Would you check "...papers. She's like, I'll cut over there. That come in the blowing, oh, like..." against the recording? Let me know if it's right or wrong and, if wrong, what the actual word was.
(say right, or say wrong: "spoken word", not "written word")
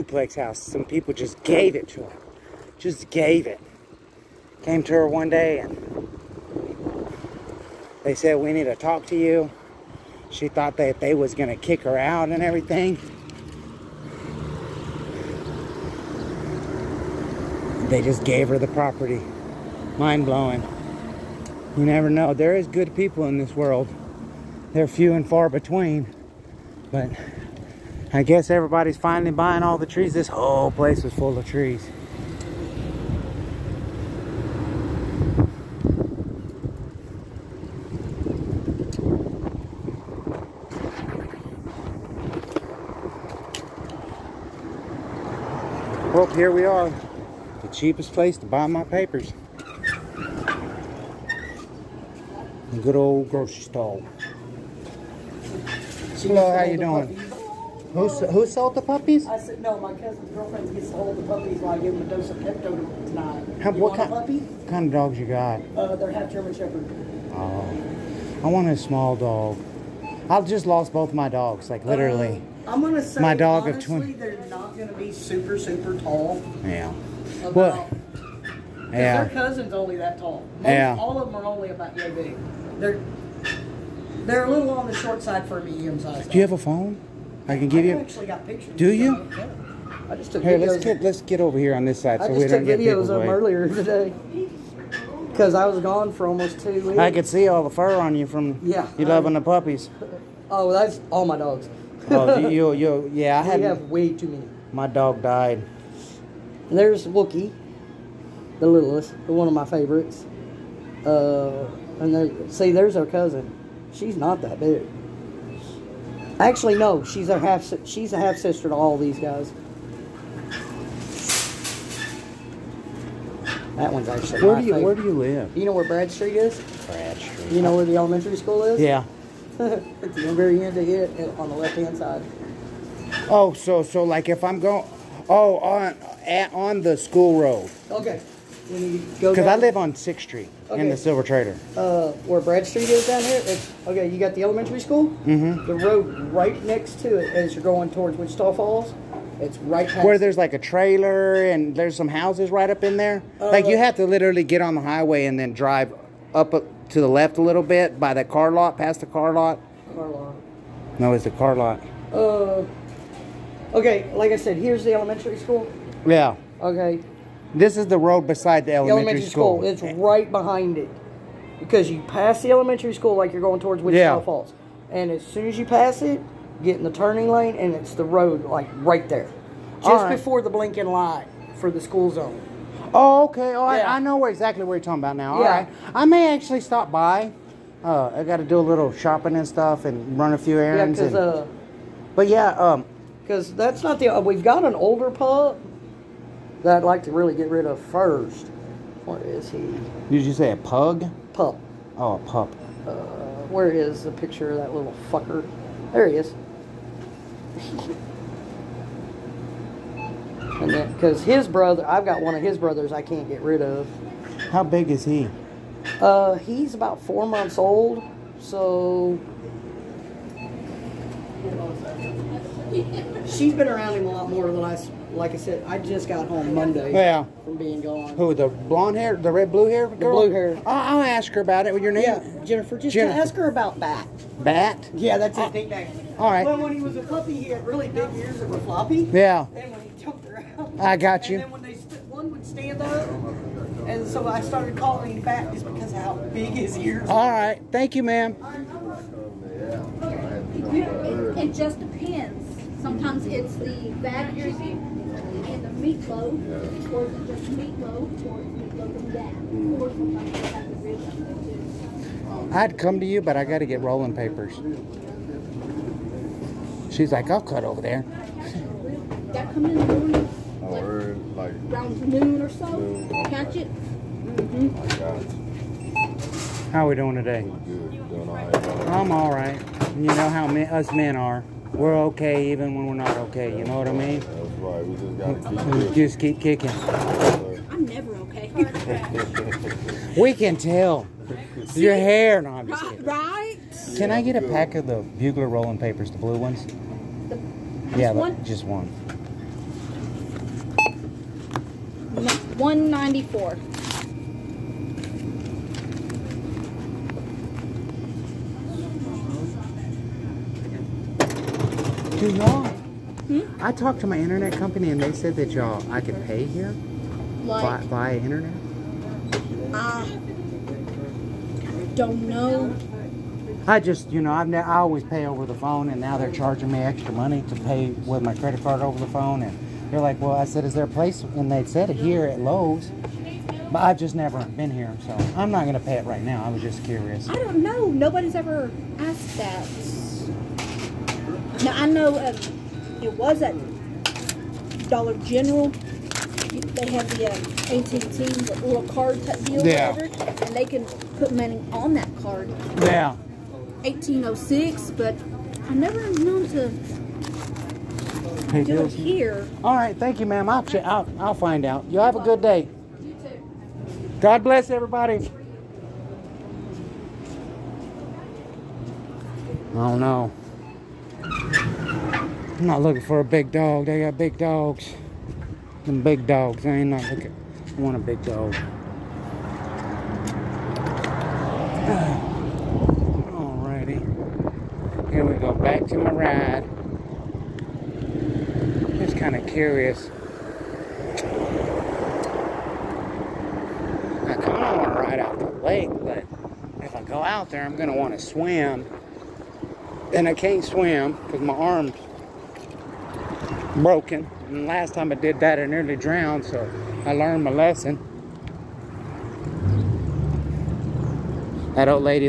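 wrong: "morning", not "blowing".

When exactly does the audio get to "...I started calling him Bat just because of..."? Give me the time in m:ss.
4:04.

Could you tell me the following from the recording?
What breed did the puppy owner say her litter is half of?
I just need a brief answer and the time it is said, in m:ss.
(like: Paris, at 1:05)
German Shepherd, at 1:06.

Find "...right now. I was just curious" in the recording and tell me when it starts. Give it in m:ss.
5:36.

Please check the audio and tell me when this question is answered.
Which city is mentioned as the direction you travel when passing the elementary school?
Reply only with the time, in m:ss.
2:28.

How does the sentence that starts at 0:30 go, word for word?
This whole place was full of trees.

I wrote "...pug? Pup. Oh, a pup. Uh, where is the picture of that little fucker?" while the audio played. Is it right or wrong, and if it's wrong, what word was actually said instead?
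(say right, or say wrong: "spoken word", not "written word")
right.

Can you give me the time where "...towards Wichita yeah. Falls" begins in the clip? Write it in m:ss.
2:53.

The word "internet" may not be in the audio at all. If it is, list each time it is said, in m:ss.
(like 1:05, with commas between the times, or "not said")
5:14, 5:18.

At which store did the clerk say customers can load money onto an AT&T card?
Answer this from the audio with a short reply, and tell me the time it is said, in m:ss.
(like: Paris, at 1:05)
Dollar General, at 5:44.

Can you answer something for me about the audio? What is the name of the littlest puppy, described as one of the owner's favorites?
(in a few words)
Wookie.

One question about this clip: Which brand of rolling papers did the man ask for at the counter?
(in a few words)
Bugler.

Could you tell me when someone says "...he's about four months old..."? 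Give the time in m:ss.
3:36.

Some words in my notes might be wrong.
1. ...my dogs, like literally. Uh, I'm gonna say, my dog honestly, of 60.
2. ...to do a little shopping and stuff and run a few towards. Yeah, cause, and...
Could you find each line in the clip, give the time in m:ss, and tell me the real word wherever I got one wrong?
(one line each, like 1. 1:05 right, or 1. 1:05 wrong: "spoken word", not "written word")
1. 1:11 wrong: "20", not "60"
2. 3:08 wrong: "errands", not "towards".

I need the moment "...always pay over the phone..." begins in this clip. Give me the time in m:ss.
5:24.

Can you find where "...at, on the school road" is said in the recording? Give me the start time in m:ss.
2:16.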